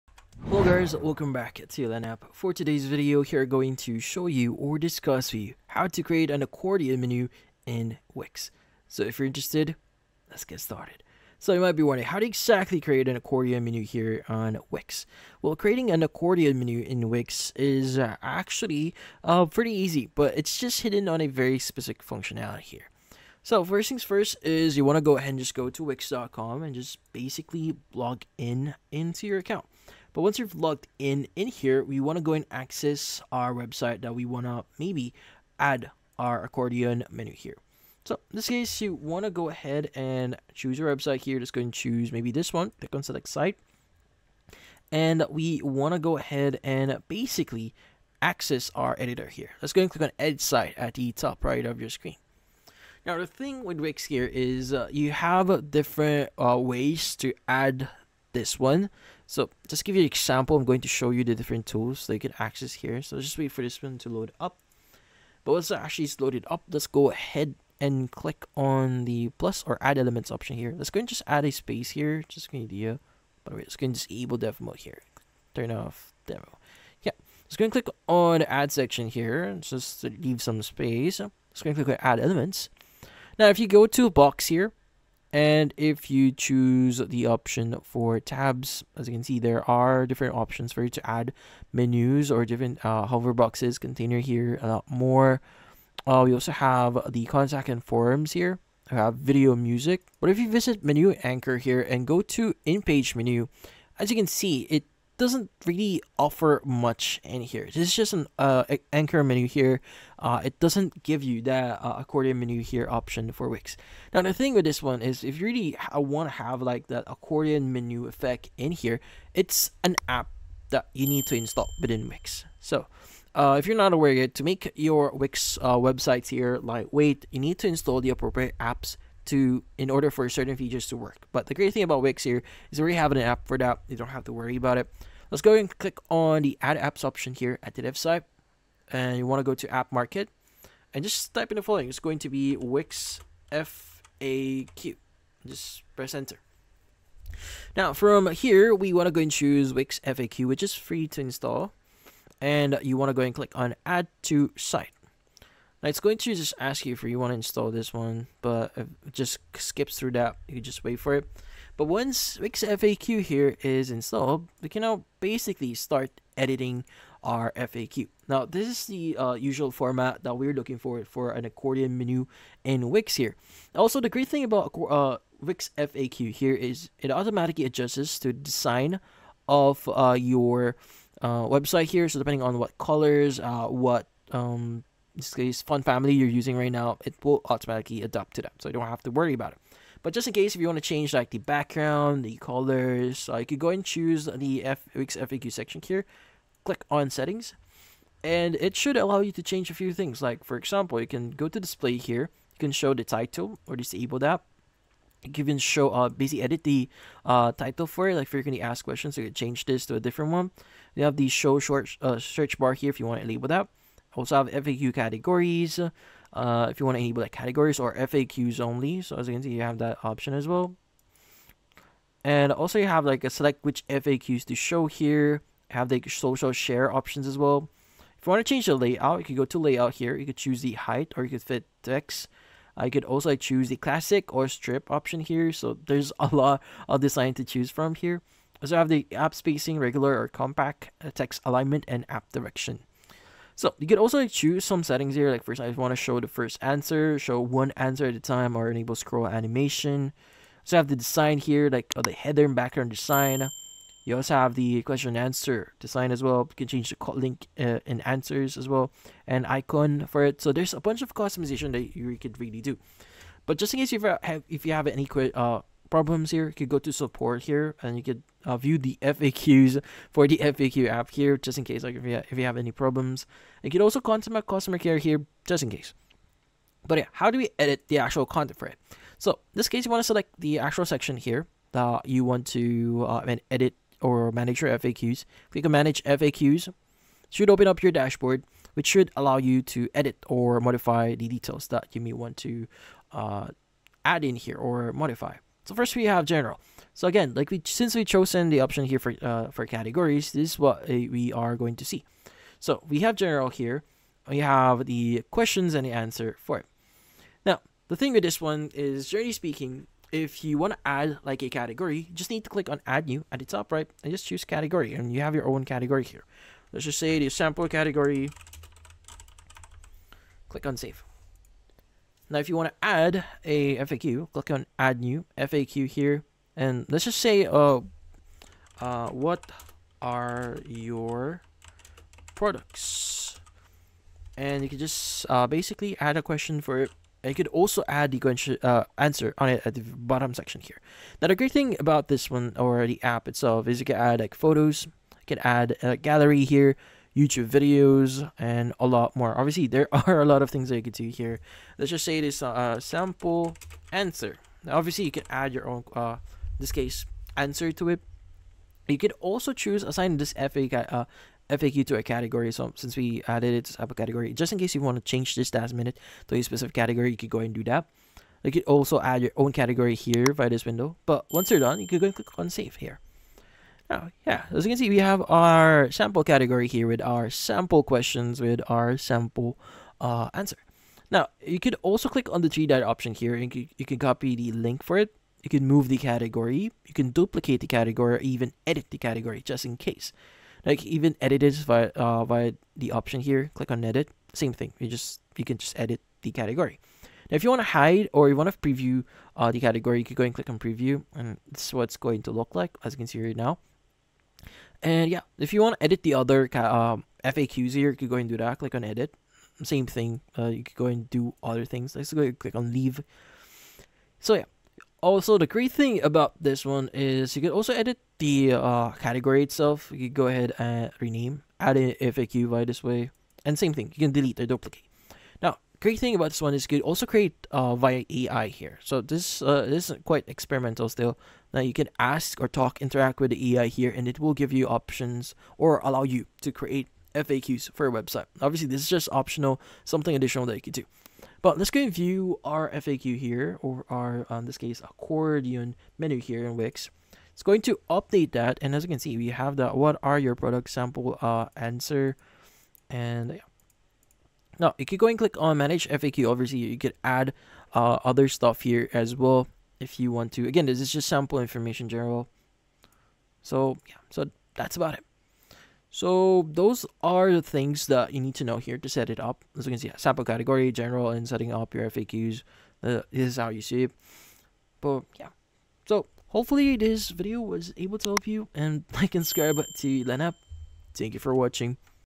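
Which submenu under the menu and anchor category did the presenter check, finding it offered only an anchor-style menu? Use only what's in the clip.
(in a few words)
in-page menu.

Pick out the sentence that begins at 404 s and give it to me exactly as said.
And yeah, if you want to edit the other um, FAQs here, you could go and do that.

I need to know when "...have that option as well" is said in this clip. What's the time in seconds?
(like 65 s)
219 s.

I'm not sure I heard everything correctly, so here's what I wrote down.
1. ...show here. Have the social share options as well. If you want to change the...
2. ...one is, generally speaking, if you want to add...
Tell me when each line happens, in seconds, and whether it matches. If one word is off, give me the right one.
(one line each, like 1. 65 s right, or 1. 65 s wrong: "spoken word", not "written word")
1. 224 s right
2. 308 s right.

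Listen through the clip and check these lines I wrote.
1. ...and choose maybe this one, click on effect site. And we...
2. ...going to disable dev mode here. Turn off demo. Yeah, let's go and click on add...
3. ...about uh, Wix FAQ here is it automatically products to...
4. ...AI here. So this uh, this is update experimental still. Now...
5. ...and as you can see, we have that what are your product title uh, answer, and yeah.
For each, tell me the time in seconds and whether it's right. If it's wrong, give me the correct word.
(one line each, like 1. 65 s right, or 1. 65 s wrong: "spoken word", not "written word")
1. 41 s wrong: "select", not "effect"
2. 73 s right
3. 174 s wrong: "adjusts", not "products"
4. 428 s wrong: "quite", not "update"
5. 448 s wrong: "sample", not "title".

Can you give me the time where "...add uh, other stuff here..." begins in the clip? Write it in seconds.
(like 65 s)
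457 s.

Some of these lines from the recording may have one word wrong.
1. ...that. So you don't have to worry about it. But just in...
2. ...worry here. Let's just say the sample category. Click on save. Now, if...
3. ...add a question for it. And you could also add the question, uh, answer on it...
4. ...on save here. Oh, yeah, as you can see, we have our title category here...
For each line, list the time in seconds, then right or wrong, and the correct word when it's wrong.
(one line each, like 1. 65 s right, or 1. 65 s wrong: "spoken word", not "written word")
1. 188 s right
2. 315 s wrong: "category", not "worry"
3. 335 s right
4. 372 s wrong: "sample", not "title".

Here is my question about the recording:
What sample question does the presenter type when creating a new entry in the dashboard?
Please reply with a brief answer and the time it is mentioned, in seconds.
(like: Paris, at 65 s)
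What are your products?, at 329 s.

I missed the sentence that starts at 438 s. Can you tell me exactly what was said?
Obviously, this is just optional, something additional that you could do.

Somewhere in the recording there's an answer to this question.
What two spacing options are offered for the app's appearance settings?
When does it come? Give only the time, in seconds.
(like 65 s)
239 s.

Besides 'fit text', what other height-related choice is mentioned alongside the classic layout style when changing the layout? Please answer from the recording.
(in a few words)
strip.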